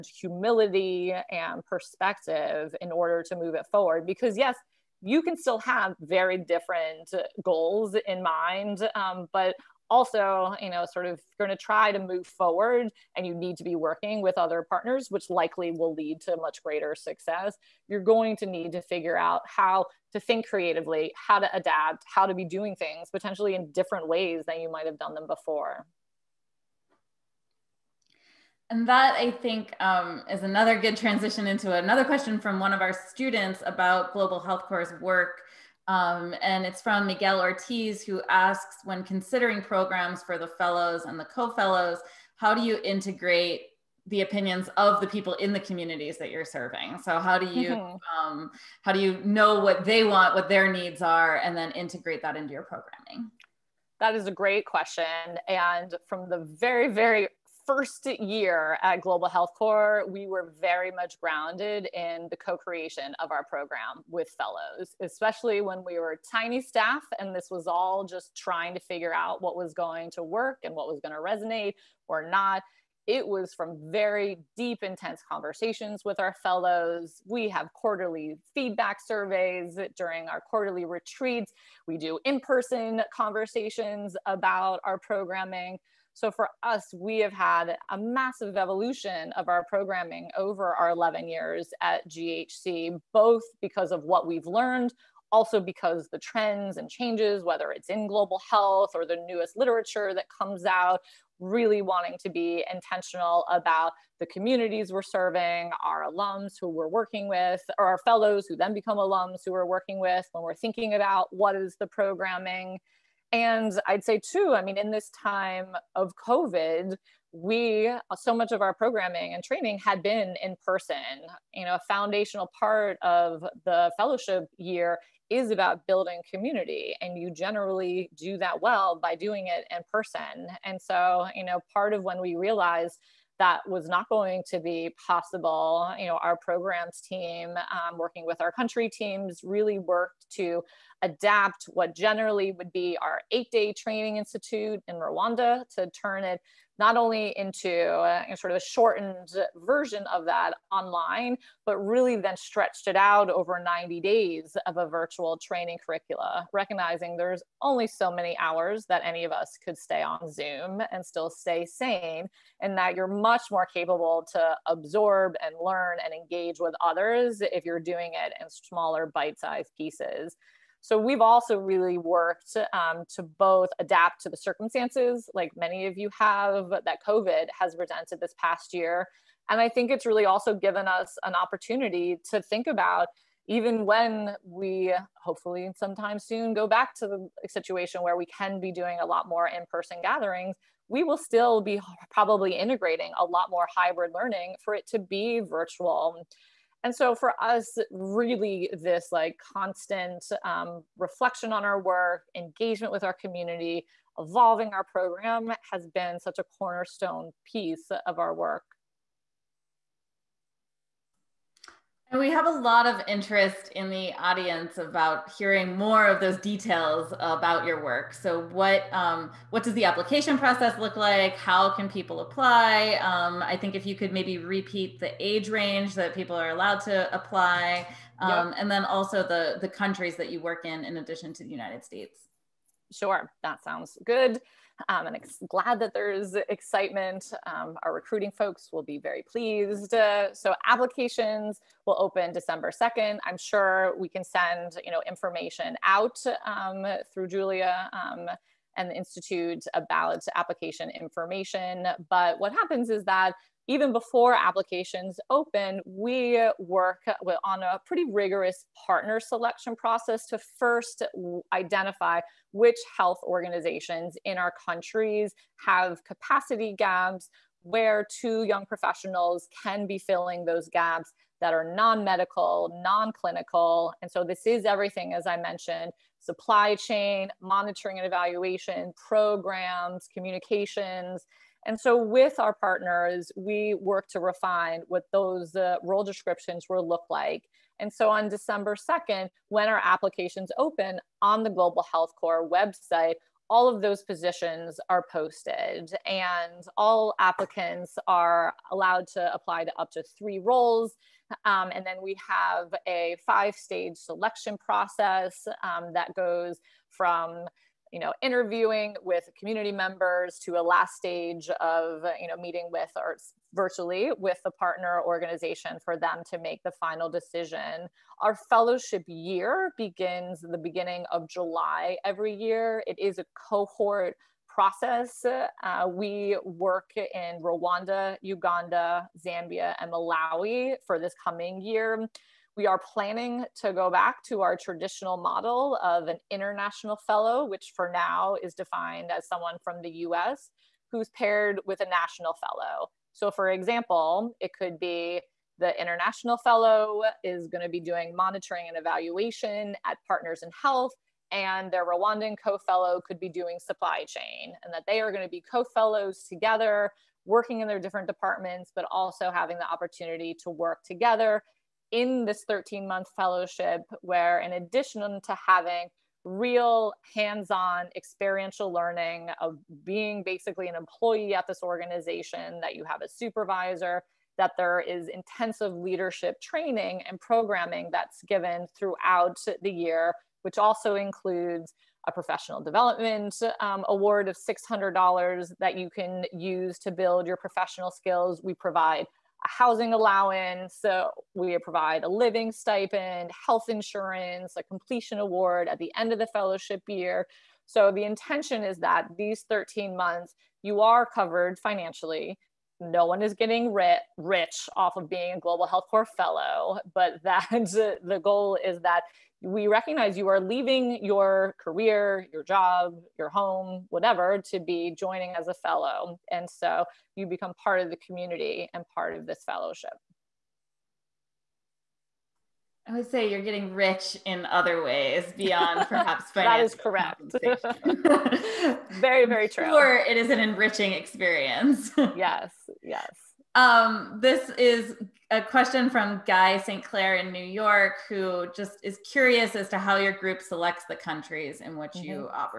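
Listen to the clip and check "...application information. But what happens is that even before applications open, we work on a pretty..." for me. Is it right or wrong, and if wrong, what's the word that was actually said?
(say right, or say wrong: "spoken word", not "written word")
right.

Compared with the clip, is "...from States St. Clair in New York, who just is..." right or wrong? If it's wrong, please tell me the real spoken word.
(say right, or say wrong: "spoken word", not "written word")
wrong: "Guy", not "States".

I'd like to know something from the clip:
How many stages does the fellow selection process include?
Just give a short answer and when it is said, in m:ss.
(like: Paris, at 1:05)
5, at 5:03.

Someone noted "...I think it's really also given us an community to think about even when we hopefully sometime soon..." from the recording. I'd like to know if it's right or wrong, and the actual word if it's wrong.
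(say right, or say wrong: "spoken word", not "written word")
wrong: "opportunity", not "community".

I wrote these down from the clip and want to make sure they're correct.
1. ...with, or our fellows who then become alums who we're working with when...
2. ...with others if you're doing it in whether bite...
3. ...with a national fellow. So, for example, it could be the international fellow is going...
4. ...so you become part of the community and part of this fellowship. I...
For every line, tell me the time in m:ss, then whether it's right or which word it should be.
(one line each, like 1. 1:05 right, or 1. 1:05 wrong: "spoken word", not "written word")
1. 1:47 right
2. 2:46 wrong: "smaller", not "whether"
3. 5:41 right
4. 6:56 right.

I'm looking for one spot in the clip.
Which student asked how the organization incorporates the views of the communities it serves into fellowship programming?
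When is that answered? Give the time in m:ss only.
0:37.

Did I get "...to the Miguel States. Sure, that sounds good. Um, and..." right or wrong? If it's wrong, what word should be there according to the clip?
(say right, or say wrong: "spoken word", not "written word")
wrong: "United", not "Miguel".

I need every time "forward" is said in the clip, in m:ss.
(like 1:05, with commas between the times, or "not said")
0:03, 0:12.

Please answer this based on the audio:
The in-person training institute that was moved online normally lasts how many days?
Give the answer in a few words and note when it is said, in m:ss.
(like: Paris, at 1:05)
8, at 2:23.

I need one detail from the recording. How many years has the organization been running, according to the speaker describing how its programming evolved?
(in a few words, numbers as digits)
11.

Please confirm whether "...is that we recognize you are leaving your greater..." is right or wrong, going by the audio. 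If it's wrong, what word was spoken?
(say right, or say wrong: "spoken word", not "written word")
wrong: "career", not "greater".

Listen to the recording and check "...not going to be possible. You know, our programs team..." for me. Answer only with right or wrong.
right.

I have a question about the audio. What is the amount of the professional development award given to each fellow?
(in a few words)
$600.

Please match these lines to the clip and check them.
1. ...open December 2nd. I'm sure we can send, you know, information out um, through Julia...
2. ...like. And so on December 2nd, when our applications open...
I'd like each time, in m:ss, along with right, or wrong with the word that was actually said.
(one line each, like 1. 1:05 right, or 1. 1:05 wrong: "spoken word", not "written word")
1. 4:01 right
2. 4:47 right.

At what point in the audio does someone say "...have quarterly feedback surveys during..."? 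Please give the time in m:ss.
1:17.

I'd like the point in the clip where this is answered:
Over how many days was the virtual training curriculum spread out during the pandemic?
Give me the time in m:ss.
2:33.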